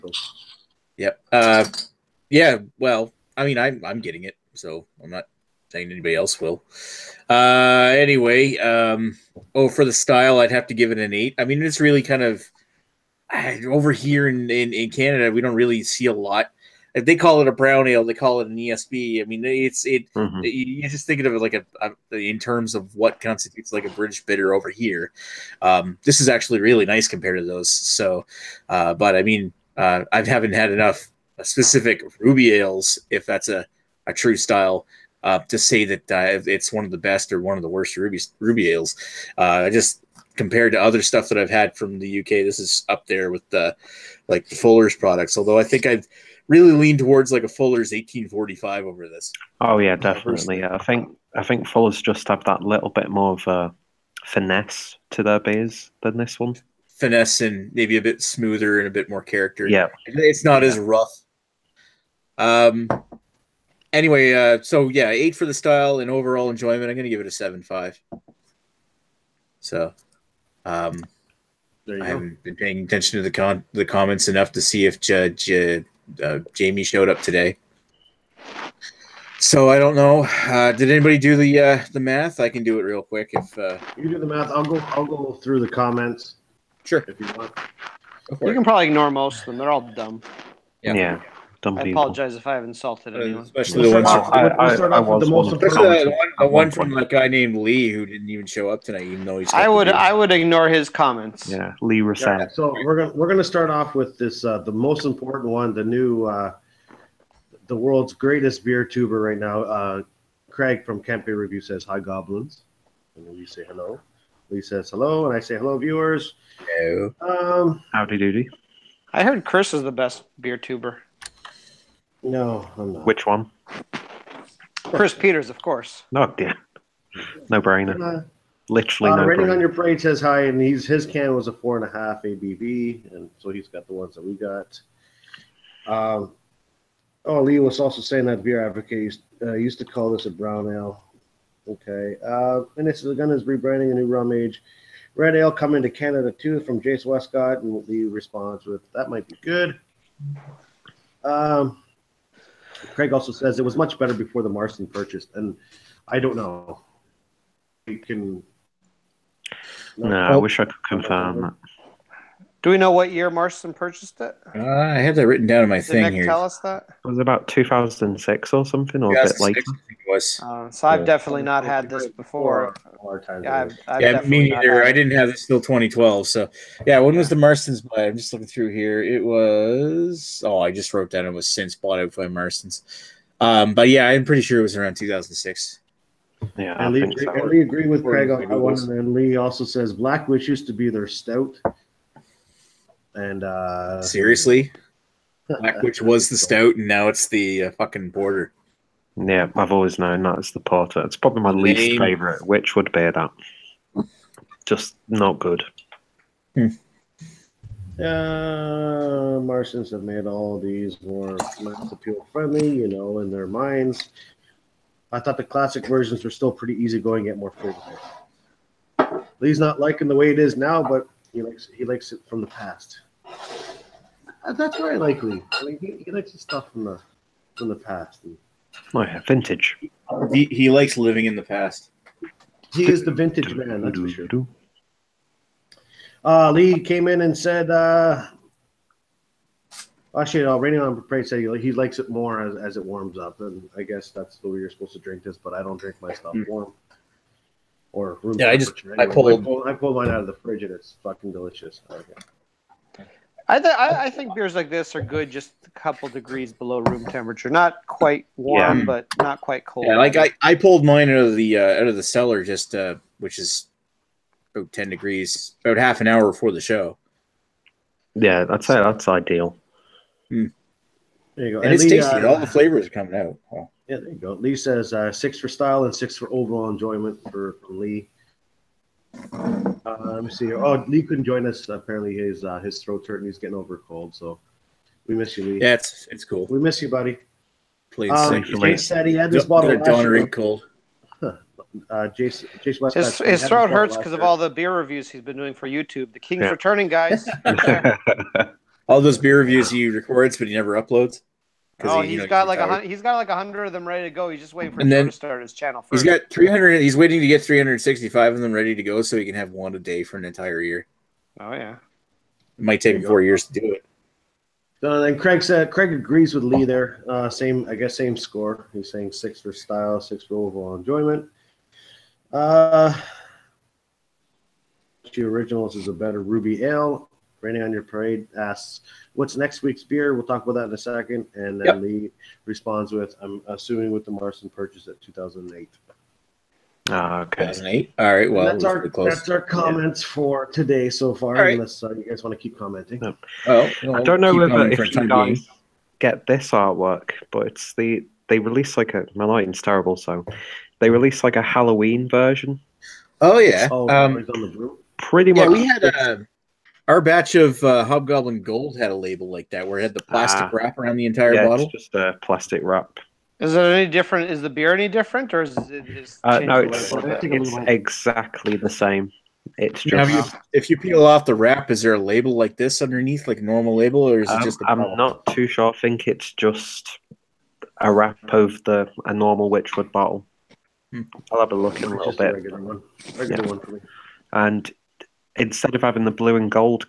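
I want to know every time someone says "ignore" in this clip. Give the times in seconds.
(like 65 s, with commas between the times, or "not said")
88 s, 100 s.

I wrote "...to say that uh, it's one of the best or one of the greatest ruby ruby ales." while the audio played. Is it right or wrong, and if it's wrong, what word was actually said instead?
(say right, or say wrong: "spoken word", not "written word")
wrong: "worst", not "greatest".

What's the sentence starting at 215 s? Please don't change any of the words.
I thought the classic versions were still pretty easy-going yet more flavorful.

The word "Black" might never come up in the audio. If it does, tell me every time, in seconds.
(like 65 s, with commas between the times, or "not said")
189 s, 195 s.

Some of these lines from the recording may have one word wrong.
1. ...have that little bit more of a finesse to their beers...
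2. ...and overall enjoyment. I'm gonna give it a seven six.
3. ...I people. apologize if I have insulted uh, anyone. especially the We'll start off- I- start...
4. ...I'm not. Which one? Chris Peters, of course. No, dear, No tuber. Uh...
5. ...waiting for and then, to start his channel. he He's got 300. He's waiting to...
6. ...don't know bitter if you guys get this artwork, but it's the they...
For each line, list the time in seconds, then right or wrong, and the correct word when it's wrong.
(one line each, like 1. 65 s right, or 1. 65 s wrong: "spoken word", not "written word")
1. 52 s right
2. 65 s wrong: "five", not "six"
3. 91 s right
4. 122 s wrong: "brainer", not "tuber"
5. 304 s right
6. 344 s wrong: "whether", not "bitter".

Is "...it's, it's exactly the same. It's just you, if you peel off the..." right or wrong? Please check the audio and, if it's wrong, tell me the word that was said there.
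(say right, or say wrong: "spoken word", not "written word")
right.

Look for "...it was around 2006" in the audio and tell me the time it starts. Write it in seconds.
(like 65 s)
184 s.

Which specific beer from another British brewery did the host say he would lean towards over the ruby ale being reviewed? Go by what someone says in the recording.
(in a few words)
Fuller's 1845.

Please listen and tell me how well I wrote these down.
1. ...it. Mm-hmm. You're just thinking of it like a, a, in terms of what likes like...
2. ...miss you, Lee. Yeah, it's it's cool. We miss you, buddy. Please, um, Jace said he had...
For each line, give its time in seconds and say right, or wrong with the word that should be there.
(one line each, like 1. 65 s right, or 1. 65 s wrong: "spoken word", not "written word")
1. 19 s wrong: "constitutes", not "likes"
2. 285 s right.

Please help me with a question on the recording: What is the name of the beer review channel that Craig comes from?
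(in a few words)
Camp Beer Review.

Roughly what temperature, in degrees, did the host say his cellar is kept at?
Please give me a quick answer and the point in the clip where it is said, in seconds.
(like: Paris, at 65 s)
10, at 264 s.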